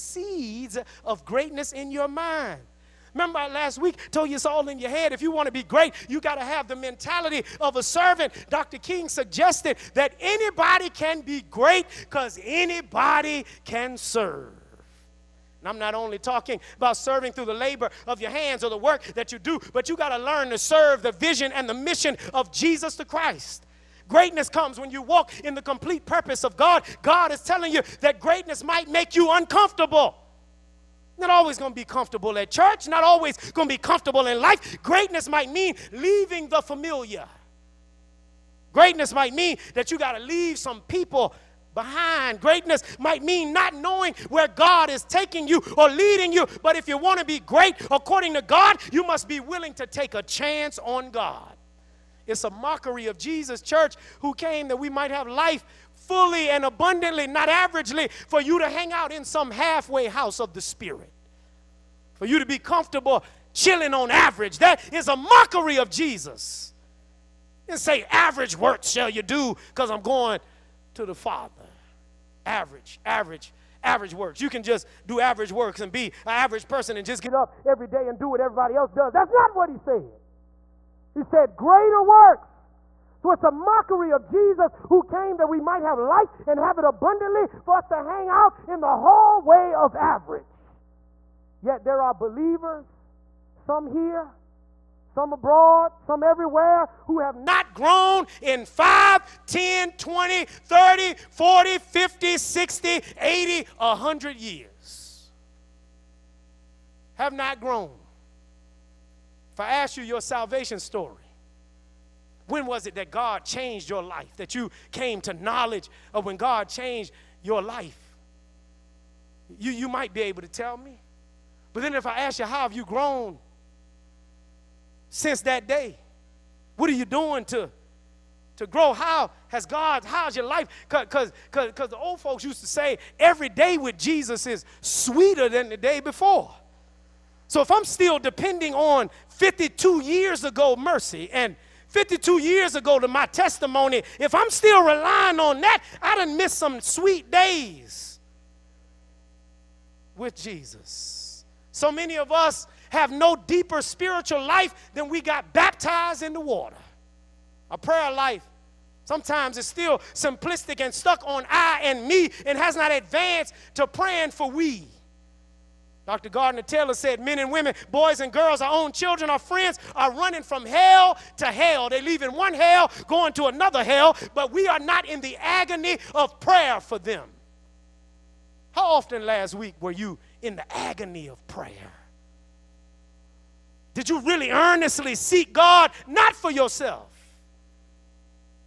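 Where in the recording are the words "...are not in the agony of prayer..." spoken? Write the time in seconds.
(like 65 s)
174 s.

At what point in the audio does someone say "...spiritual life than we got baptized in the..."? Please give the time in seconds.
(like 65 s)
153 s.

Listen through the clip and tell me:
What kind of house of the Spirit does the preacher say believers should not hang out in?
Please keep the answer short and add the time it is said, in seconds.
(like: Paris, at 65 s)
halfway house, at 59 s.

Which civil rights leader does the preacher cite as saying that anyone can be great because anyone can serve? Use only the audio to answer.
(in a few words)
Dr. King.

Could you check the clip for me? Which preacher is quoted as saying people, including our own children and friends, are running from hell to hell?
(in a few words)
Dr. Gardner Taylor.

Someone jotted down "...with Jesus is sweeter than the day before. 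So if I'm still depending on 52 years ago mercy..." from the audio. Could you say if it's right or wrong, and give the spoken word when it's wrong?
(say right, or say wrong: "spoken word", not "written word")
right.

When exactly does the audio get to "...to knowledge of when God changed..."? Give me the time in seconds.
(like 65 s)
115 s.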